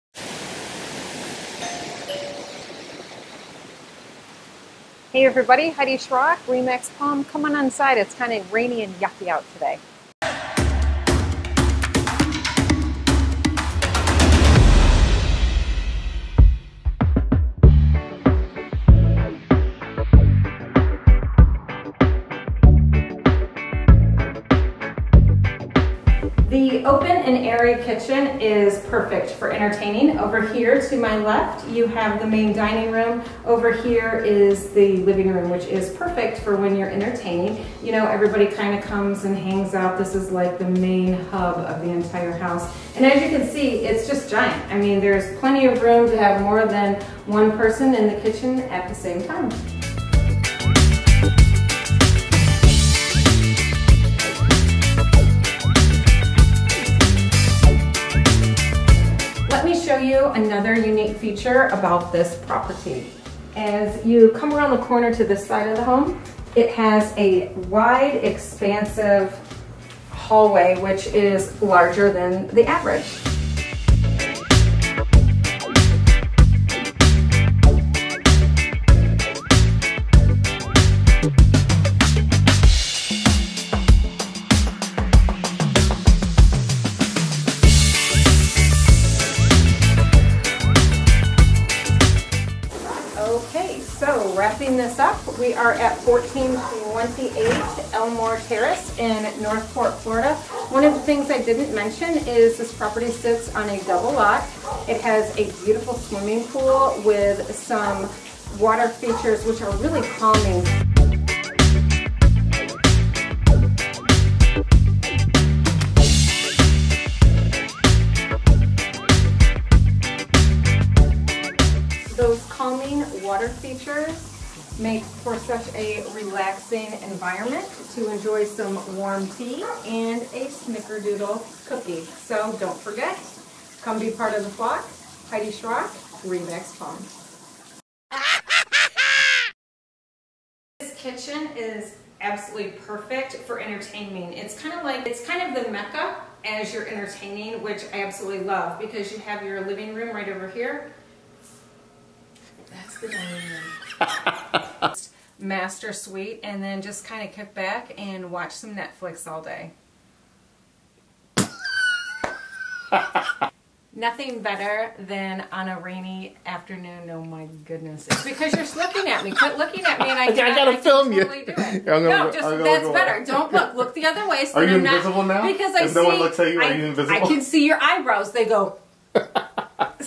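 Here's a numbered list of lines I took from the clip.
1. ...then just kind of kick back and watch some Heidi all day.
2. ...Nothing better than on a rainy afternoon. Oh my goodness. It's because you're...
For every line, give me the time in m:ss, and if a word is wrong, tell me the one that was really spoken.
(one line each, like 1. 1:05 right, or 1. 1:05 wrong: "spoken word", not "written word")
1. 2:36 wrong: "Netflix", not "Heidi"
2. 2:43 right.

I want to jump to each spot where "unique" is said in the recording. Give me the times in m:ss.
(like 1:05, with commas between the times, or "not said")
1:00.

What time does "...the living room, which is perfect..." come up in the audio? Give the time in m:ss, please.
0:34.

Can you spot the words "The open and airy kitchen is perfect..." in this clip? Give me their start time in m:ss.
0:26.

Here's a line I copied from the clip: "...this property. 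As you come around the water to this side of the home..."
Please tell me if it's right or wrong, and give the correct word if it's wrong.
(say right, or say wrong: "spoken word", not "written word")
wrong: "corner", not "water".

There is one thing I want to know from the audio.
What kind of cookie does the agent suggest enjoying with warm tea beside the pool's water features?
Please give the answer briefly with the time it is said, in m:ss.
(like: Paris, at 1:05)
snickerdoodle, at 2:10.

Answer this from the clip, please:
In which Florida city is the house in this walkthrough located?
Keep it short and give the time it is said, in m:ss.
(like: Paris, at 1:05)
North Port, at 1:39.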